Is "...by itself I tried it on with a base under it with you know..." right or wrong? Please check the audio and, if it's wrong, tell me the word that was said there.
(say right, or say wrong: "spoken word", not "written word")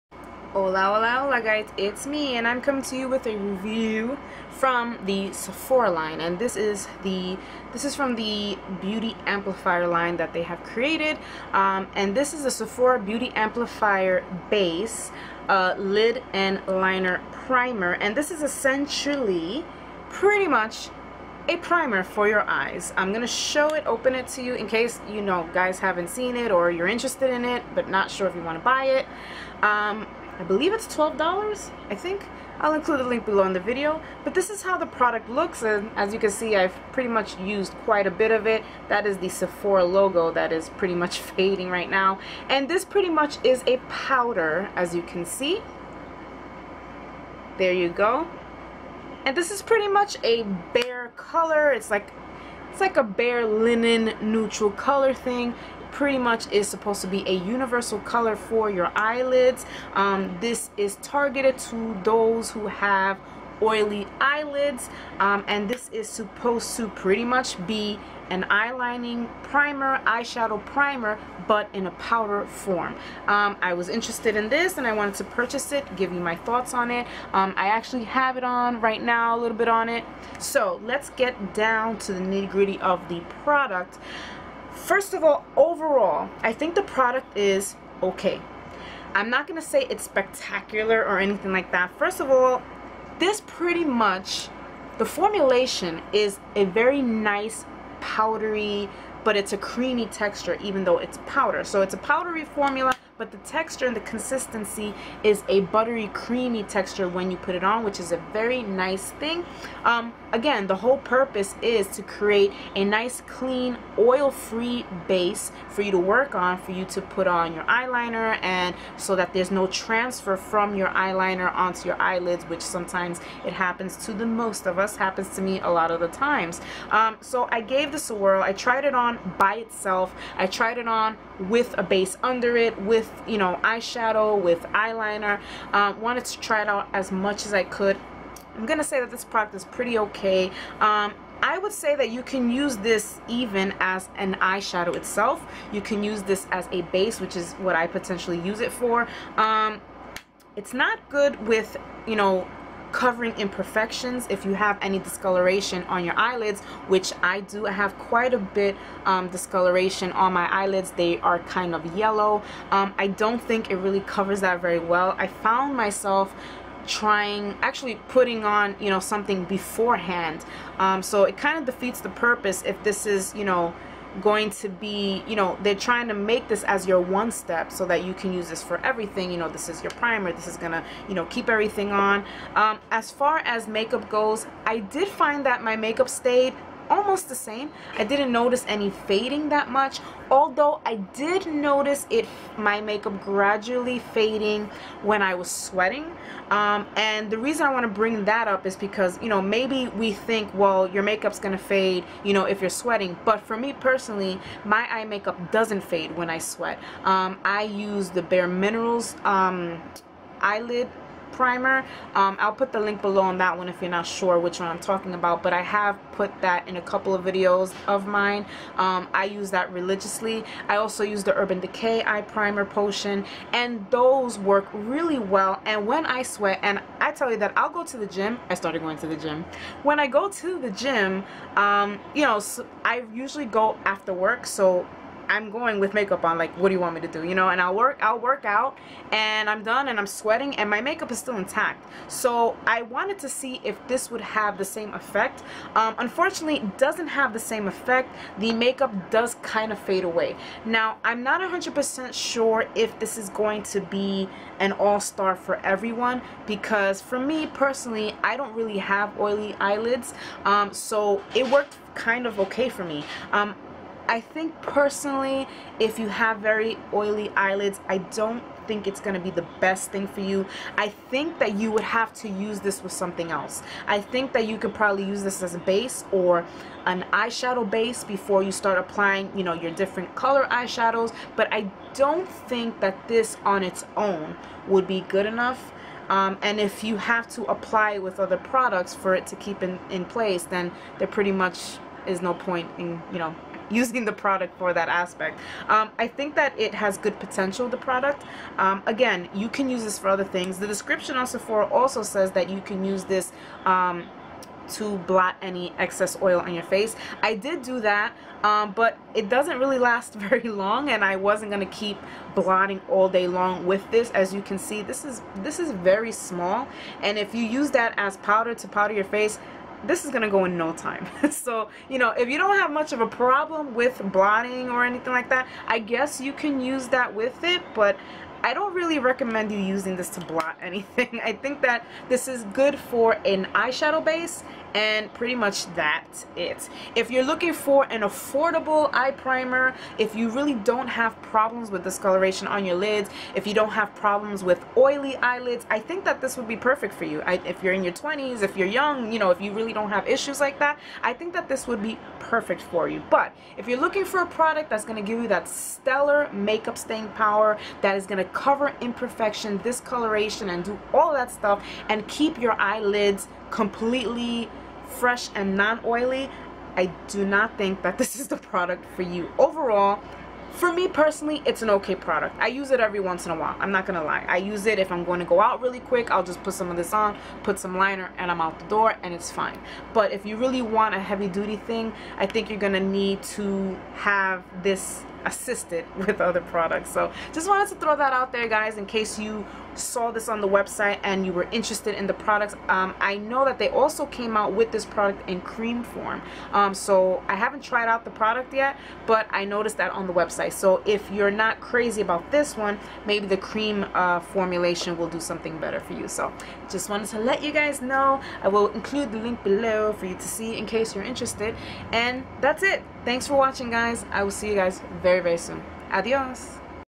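right.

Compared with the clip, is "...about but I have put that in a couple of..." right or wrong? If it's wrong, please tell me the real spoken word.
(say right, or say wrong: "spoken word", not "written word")
right.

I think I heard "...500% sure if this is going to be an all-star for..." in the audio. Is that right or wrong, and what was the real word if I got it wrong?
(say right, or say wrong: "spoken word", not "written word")
wrong: "100", not "500".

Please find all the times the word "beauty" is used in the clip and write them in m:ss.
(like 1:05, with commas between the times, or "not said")
0:08, 0:12.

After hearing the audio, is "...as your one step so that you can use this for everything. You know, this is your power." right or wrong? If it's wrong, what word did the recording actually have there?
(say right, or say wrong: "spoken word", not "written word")
wrong: "primer", not "power".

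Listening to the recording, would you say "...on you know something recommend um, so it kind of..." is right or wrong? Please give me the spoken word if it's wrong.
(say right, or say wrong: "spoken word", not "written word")
wrong: "beforehand", not "recommend".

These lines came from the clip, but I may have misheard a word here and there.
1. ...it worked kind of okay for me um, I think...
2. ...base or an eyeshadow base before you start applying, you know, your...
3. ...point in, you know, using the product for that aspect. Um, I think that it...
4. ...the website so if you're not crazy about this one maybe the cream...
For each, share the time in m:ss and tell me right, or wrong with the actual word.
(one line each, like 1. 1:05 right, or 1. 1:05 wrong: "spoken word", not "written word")
1. 4:21 right
2. 4:35 right
3. 4:52 right
4. 6:40 right.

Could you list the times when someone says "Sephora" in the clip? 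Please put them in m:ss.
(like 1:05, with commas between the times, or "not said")
0:05, 0:12, 0:39, 5:01.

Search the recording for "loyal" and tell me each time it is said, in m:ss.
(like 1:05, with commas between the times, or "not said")
not said.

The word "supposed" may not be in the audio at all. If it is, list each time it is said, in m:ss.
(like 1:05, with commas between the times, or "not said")
0:56, 1:06.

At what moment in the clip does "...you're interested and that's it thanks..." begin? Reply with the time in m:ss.
6:50.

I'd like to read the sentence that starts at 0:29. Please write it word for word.
Um, I believe it's $12, I think.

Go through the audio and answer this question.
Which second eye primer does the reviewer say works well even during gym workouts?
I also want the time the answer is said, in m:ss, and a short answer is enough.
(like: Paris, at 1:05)
Urban Decay eye primer potion, at 3:41.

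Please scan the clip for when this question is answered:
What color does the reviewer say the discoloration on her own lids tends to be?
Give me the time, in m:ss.
2:41.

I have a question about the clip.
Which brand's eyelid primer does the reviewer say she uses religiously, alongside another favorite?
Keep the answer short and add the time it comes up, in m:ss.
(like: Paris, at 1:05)
Bare Minerals, at 3:28.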